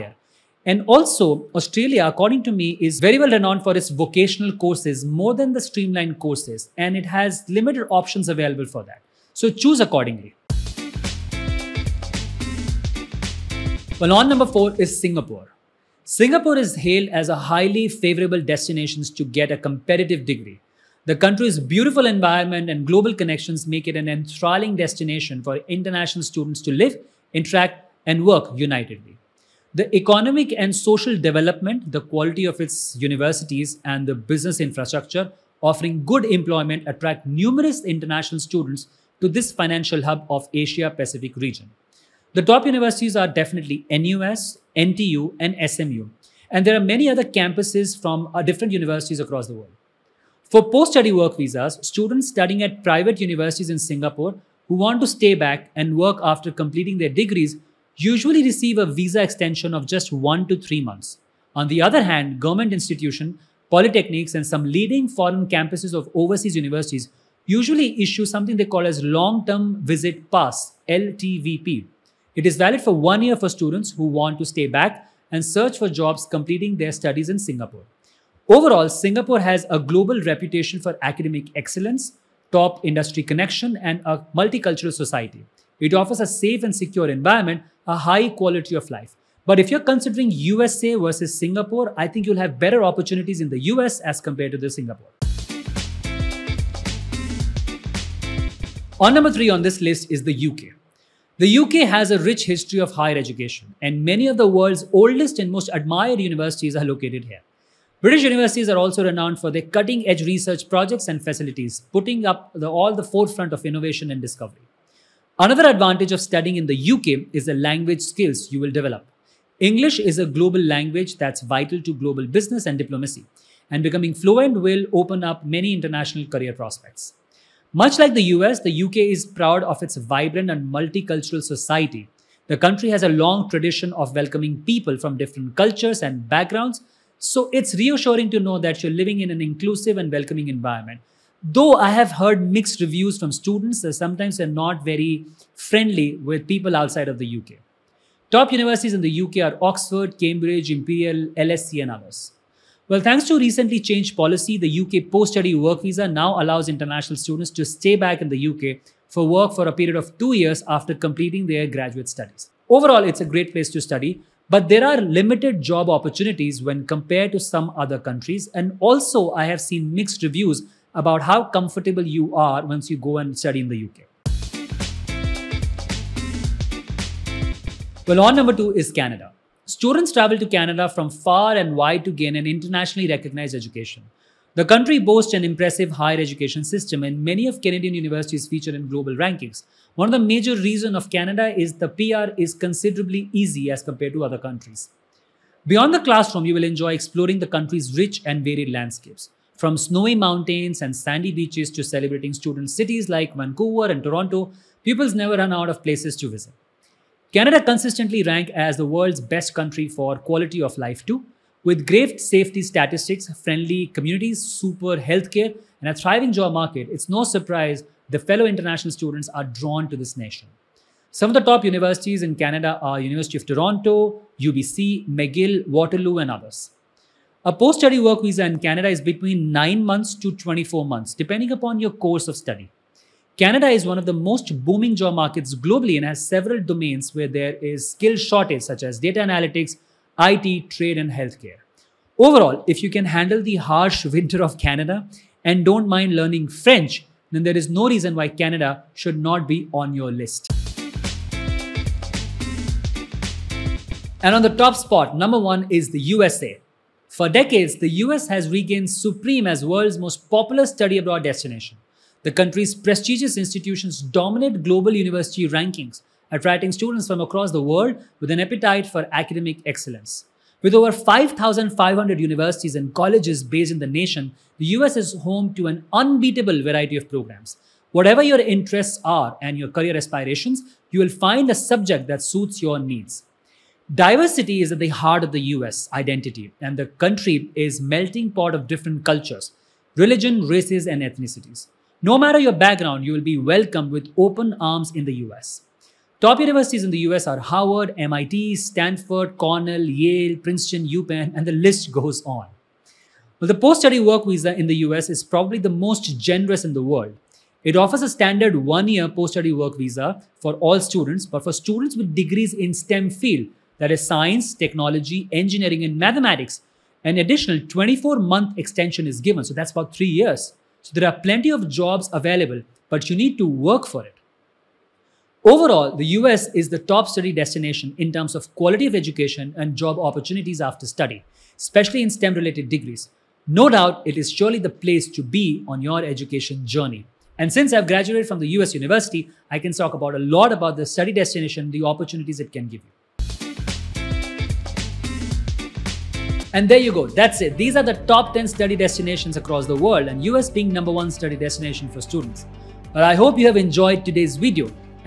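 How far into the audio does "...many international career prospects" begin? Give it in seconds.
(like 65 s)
125 s.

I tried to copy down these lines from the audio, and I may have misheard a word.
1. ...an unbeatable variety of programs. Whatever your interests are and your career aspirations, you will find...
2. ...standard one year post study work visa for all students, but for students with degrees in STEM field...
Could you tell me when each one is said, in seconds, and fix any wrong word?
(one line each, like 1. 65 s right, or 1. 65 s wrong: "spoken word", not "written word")
1. 275 s right
2. 308 s right.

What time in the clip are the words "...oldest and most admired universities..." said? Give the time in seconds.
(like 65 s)
104 s.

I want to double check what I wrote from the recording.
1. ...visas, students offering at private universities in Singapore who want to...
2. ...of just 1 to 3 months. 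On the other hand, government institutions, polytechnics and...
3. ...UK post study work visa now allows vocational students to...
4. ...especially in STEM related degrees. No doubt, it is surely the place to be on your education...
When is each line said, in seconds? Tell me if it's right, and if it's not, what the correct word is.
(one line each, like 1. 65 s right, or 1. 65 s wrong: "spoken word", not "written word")
1. 51 s wrong: "studying", not "offering"
2. 59 s right
3. 154 s wrong: "international", not "vocational"
4. 331 s right.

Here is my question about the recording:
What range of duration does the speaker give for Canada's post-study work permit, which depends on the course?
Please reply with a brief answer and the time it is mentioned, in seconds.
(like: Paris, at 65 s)
9 to 24 months, at 229 s.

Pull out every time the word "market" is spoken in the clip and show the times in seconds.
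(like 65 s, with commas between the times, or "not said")
216 s, 235 s.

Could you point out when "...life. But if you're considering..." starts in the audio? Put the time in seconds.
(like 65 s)
88 s.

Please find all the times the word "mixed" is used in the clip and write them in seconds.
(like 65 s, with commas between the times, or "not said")
142 s, 169 s.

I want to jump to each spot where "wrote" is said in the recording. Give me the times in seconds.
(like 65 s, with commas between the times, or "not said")
not said.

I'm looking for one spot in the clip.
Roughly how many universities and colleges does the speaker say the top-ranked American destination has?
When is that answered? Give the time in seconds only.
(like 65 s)
270 s.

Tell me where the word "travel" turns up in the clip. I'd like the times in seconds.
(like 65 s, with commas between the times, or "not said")
180 s.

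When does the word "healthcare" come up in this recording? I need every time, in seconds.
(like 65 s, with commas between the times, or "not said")
214 s, 241 s.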